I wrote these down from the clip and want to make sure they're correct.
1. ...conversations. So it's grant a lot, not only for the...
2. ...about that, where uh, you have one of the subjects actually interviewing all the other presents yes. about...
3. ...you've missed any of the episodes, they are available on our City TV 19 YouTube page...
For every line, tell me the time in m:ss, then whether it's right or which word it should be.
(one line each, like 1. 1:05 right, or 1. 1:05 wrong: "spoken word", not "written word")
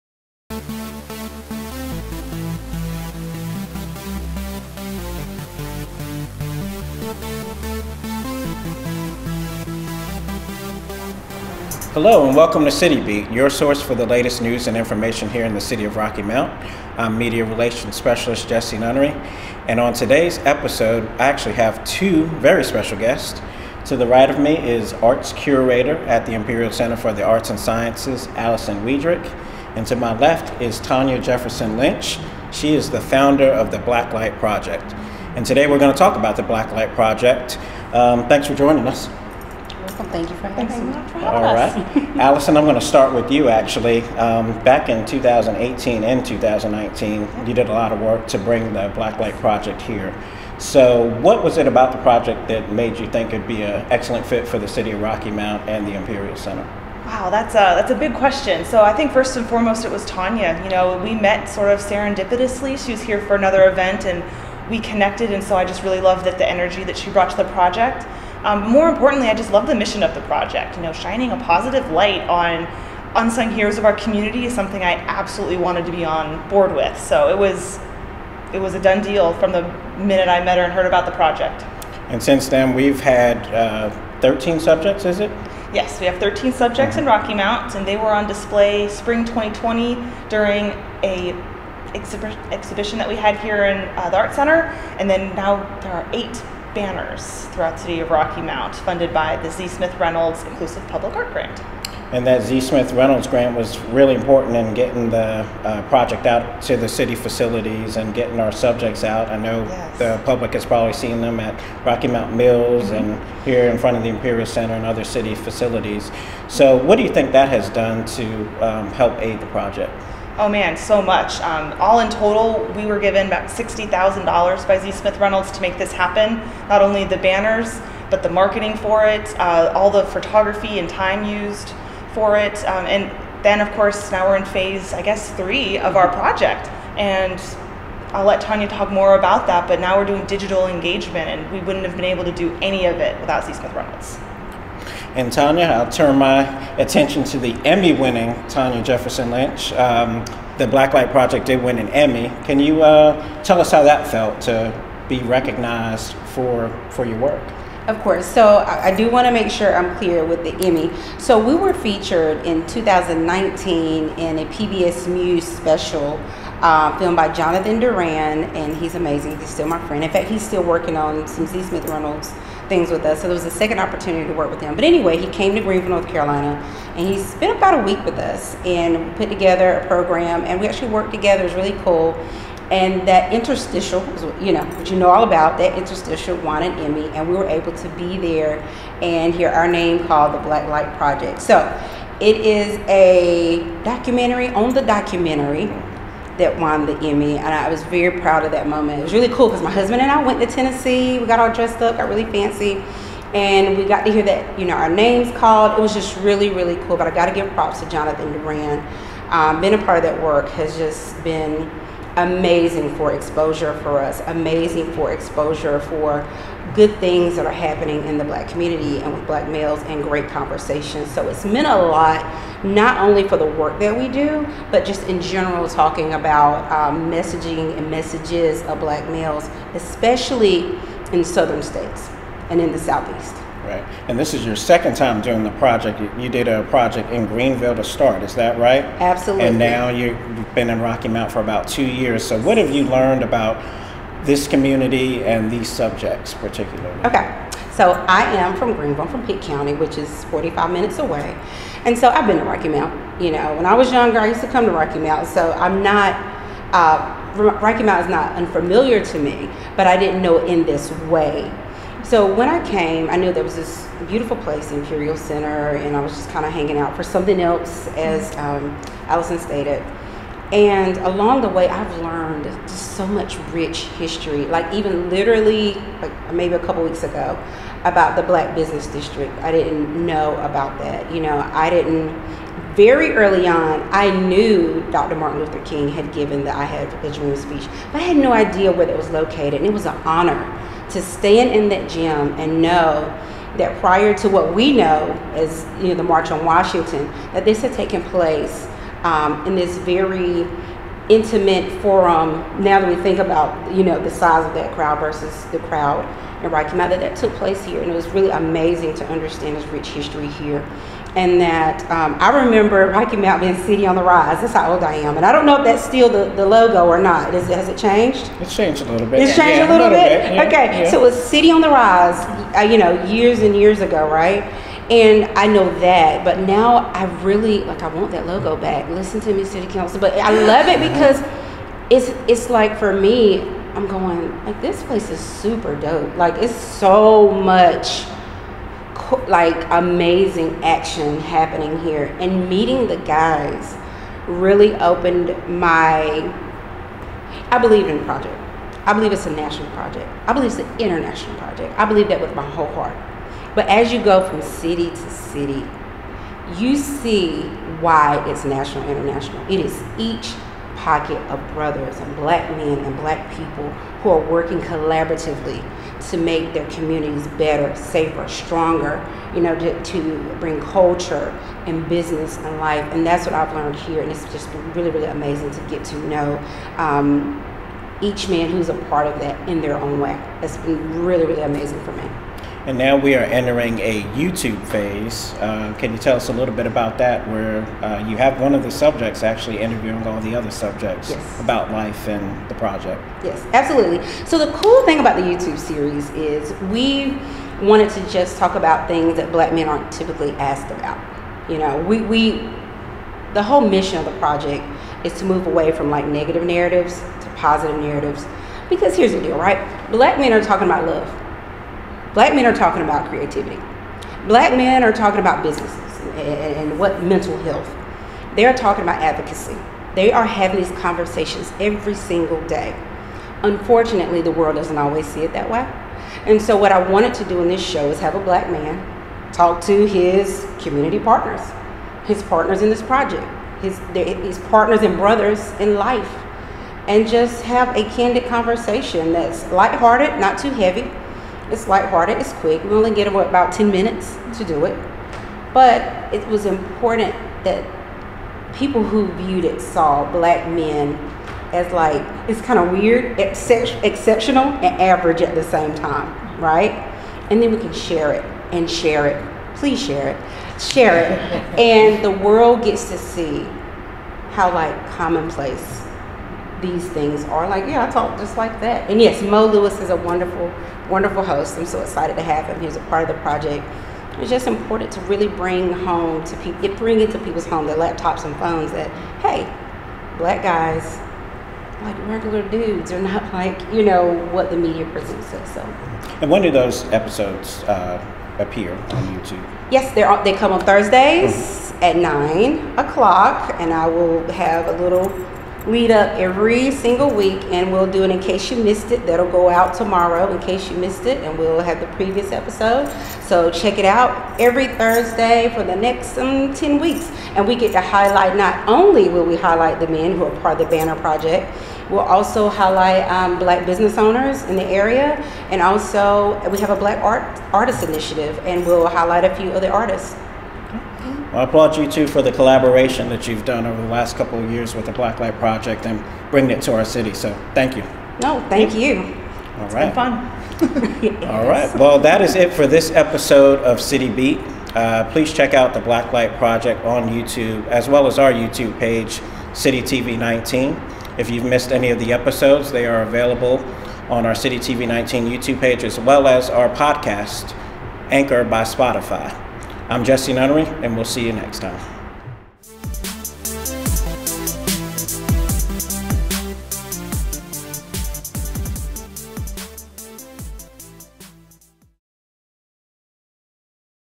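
1. 3:40 wrong: "meant", not "grant"
2. 6:26 wrong: "subjects", not "presents"
3. 9:01 right.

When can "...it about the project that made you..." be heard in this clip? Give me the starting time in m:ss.
0:51.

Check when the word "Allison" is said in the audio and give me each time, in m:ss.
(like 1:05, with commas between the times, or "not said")
0:28, 0:42, 4:29.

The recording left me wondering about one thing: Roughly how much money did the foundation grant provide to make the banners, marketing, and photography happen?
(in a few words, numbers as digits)
$60,000.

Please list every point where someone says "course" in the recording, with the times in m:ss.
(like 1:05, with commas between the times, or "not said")
2:13, 2:38.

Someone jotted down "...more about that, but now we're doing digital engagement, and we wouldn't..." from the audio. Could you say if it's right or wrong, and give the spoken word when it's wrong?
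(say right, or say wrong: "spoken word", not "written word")
right.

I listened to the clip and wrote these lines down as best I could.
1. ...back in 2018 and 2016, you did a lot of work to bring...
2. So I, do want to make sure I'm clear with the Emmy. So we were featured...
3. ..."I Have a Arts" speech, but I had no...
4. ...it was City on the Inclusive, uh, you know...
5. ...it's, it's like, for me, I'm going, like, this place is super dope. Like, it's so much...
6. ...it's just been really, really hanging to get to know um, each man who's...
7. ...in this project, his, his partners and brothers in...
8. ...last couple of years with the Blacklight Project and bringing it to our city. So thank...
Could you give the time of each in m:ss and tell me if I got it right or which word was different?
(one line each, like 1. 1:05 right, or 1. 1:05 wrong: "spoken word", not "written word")
1. 0:44 wrong: "2019", not "2016"
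2. 2:38 right
3. 4:46 wrong: "Dream", not "Arts"
4. 5:21 wrong: "Rise", not "Inclusive"
5. 5:31 right
6. 6:14 wrong: "amazing", not "hanging"
7. 7:12 right
8. 8:43 right.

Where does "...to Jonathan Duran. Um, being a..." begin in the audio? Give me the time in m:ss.
3:27.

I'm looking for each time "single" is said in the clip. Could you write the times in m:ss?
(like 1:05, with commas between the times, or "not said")
7:01, 8:16.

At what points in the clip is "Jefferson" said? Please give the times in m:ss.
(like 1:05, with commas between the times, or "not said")
0:31, 2:28.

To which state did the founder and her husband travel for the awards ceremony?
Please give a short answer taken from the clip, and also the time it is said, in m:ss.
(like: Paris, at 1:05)
Tennessee, at 3:20.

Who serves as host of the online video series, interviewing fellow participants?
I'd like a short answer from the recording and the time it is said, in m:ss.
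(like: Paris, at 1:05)
Mo Lewis, at 7:49.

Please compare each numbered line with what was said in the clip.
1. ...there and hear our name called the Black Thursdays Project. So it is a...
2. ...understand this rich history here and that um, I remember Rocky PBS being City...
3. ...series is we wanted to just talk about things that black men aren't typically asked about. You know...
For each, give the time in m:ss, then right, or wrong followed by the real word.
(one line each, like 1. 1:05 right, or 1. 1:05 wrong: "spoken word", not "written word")
1. 3:08 wrong: "Light", not "Thursdays"
2. 5:09 wrong: "Mountain", not "PBS"
3. 6:35 right.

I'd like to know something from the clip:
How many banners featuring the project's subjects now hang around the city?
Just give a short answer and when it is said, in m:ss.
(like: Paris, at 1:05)
8, at 1:36.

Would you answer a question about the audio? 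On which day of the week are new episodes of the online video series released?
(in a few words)
Thursdays.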